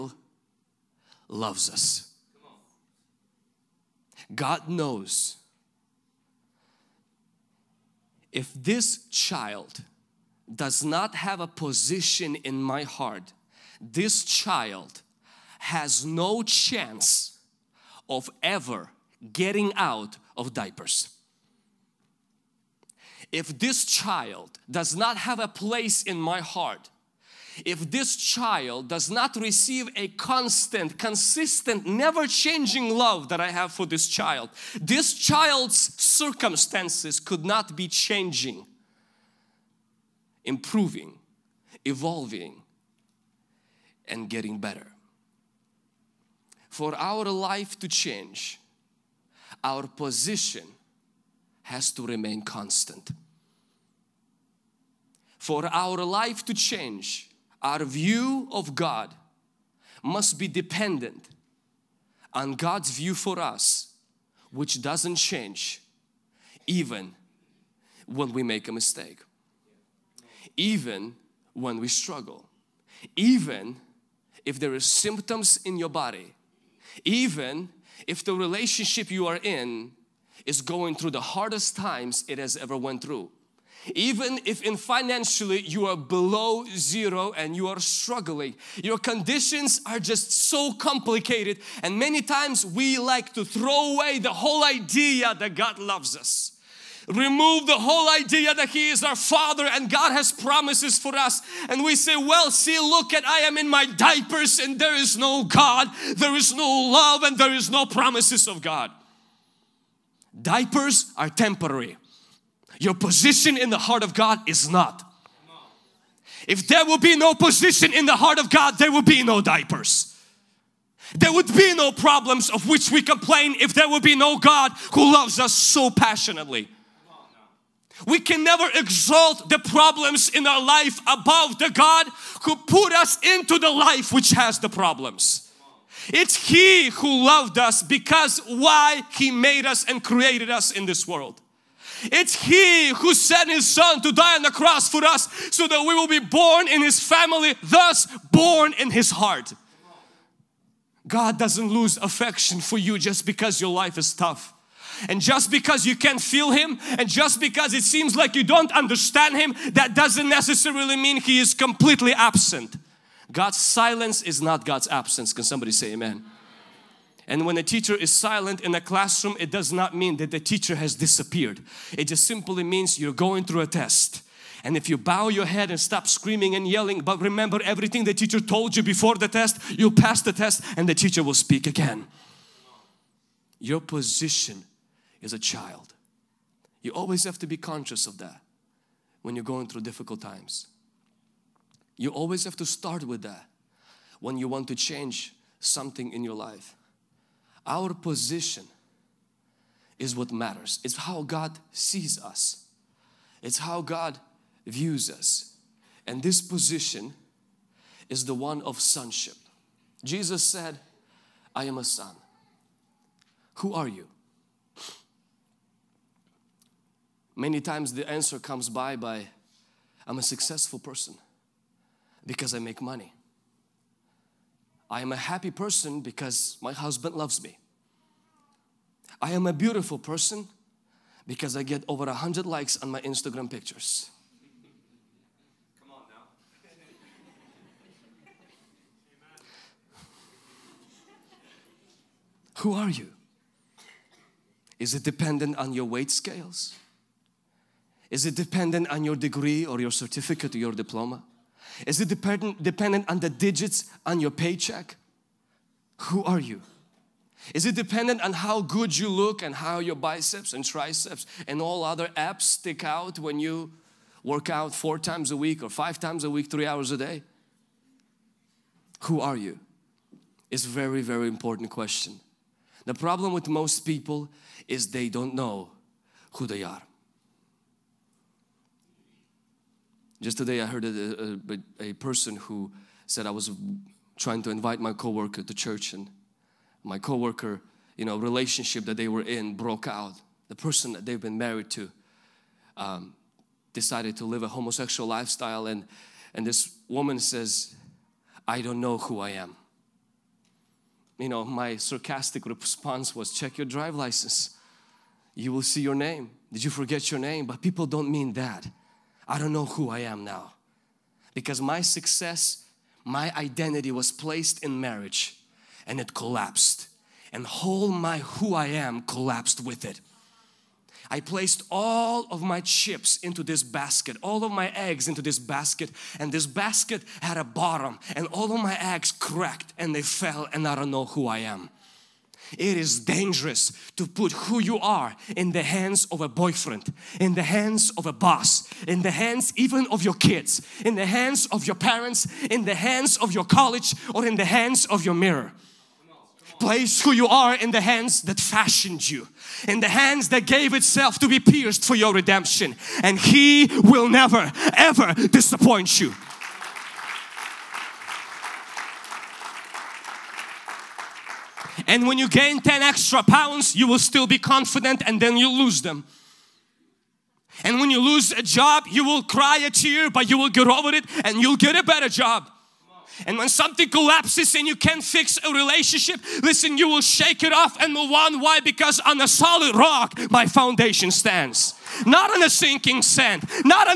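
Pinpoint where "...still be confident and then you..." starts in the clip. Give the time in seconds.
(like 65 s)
363 s.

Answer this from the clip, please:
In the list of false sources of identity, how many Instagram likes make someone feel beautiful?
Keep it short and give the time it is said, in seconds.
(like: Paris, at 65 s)
Over 100, at 231 s.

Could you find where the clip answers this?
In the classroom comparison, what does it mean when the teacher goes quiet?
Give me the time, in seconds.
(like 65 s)
172 s.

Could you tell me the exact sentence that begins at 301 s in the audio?
You know, my sarcastic response was, check your drive license.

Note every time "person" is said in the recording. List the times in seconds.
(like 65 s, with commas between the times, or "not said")
220 s, 225 s, 229 s, 281 s, 290 s.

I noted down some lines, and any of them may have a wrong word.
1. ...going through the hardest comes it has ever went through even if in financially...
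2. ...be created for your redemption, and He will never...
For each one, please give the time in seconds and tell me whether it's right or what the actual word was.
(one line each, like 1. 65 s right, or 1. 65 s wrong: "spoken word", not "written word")
1. 80 s wrong: "times", not "comes"
2. 351 s wrong: "pierced", not "created".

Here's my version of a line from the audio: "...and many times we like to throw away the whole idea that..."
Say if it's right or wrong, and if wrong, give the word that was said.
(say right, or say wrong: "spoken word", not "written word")
right.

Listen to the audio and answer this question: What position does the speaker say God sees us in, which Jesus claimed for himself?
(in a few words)
Sonship.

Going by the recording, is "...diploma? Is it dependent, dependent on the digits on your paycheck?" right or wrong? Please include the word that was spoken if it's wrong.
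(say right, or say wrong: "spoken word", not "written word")
right.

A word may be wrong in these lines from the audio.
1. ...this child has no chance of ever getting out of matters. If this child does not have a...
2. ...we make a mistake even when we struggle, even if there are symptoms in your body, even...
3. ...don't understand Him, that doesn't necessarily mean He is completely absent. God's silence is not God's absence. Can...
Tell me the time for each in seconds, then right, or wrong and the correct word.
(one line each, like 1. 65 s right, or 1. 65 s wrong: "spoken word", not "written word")
1. 13 s wrong: "diapers", not "matters"
2. 68 s right
3. 158 s right.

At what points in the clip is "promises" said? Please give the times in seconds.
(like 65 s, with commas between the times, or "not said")
100 s, 107 s.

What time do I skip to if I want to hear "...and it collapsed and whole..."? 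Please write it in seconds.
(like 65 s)
315 s.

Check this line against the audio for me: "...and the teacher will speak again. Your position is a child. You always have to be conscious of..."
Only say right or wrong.
right.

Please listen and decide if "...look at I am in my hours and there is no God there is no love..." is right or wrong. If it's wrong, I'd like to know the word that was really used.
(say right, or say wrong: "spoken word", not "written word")
wrong: "diapers", not "hours".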